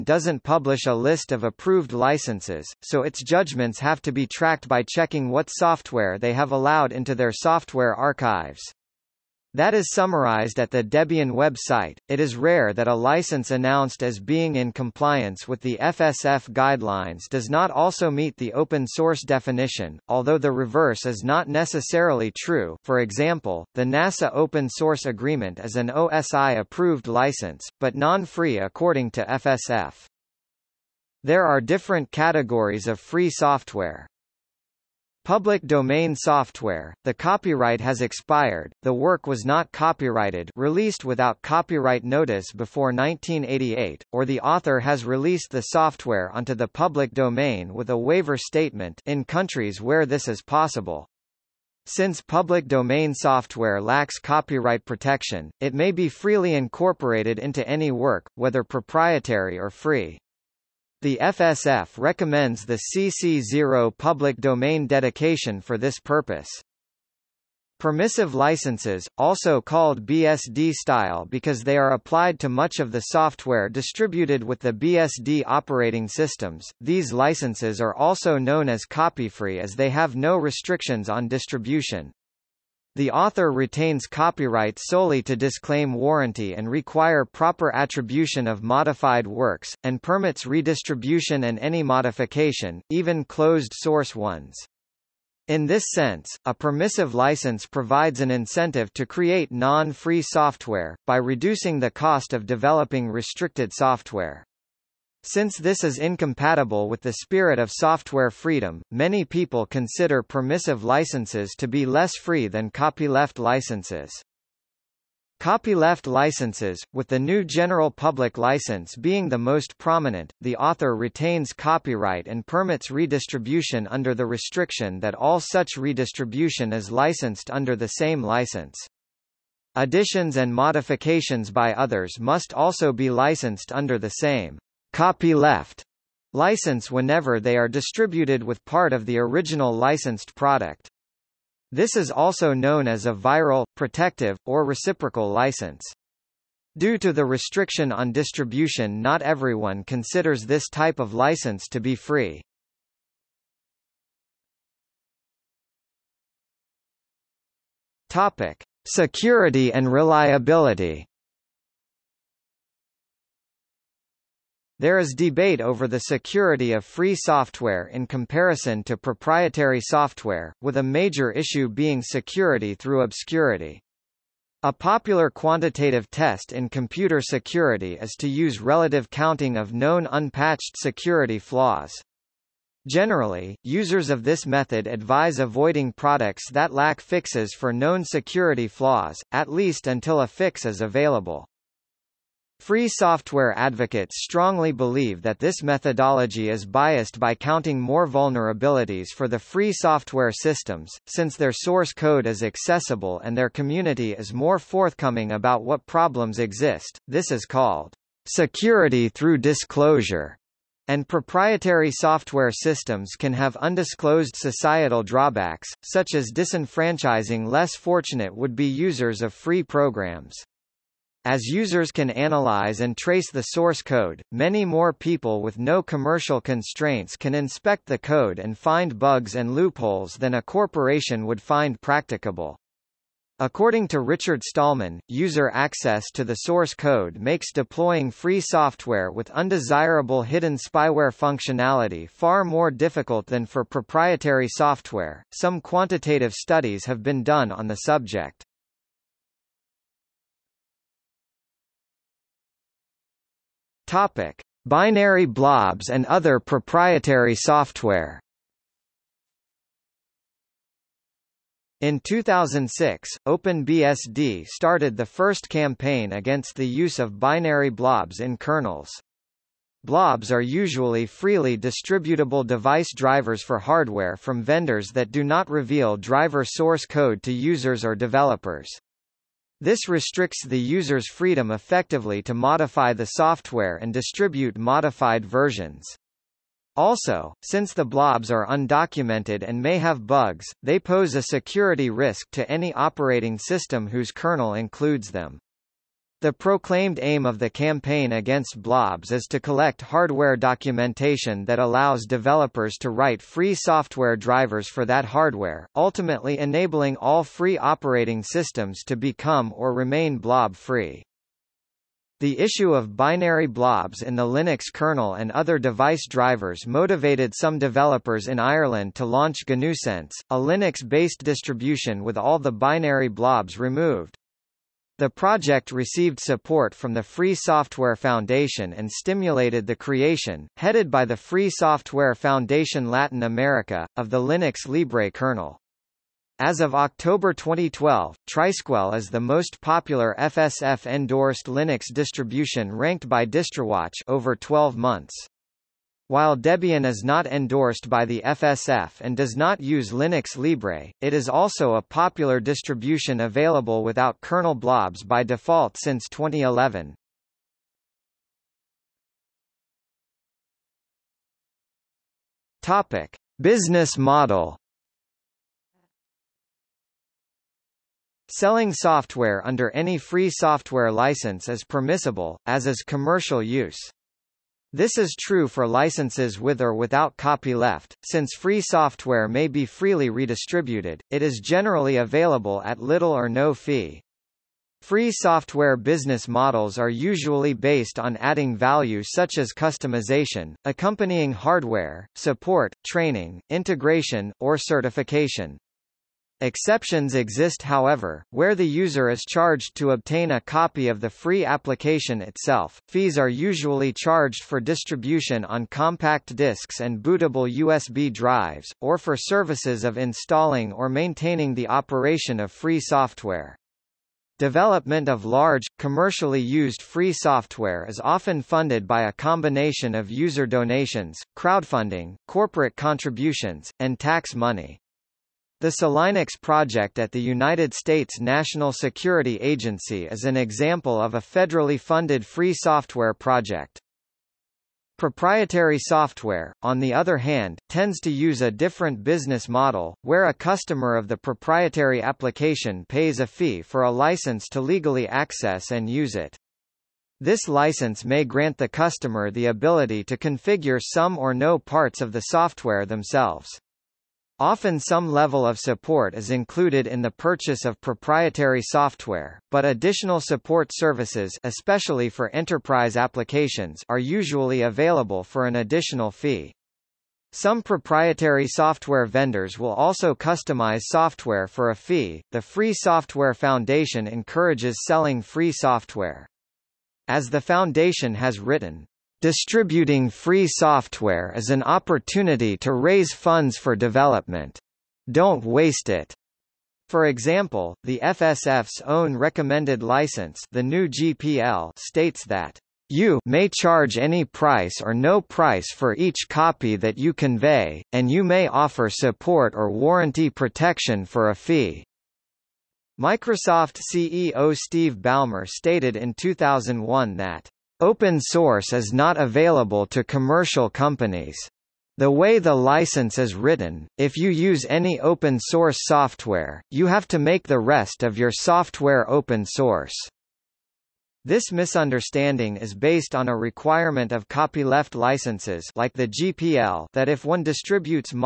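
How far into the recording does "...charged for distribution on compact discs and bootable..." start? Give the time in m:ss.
6:43.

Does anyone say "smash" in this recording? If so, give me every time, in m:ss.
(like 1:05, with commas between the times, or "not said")
not said.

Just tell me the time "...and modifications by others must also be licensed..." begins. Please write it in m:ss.
2:10.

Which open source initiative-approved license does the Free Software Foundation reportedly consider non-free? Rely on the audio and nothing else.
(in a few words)
NASA Open Source Agreement.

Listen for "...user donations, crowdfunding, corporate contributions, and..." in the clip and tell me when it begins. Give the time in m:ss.
7:00.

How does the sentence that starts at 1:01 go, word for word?
The FSF recommends the CC0 public domain dedication for this purpose.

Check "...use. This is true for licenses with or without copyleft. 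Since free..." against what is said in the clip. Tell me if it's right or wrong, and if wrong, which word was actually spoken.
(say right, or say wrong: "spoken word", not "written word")
right.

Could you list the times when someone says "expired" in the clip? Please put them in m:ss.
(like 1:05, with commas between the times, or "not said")
0:37.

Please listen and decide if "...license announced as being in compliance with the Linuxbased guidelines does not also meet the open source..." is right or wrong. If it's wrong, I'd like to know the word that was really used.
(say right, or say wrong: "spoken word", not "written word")
wrong: "FSF", not "Linuxbased".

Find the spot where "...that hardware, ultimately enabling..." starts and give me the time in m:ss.
5:04.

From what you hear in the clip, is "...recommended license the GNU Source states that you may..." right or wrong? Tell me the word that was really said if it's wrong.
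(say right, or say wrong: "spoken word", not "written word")
wrong: "GPL", not "Source".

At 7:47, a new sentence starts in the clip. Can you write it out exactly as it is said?
Some proprietary software vendors will also customize software for a fee.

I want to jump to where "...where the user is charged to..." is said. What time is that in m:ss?
6:38.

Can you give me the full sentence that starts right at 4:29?
Blobs are usually freely distributable device drivers for hardware from vendors that do not reveal driver source code to users or developers.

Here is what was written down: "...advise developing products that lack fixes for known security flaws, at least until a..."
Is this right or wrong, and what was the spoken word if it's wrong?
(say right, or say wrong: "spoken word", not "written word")
wrong: "avoiding", not "developing".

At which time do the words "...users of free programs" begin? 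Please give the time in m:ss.
3:38.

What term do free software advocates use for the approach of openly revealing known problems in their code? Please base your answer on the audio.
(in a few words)
security through disclosure.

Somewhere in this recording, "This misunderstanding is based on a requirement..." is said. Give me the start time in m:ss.
8:41.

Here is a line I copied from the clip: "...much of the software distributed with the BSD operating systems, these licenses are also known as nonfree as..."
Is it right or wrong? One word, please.
wrong.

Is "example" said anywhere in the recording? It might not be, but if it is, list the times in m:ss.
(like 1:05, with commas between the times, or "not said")
0:22, 7:10, 8:07.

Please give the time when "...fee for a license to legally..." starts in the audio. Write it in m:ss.
7:23.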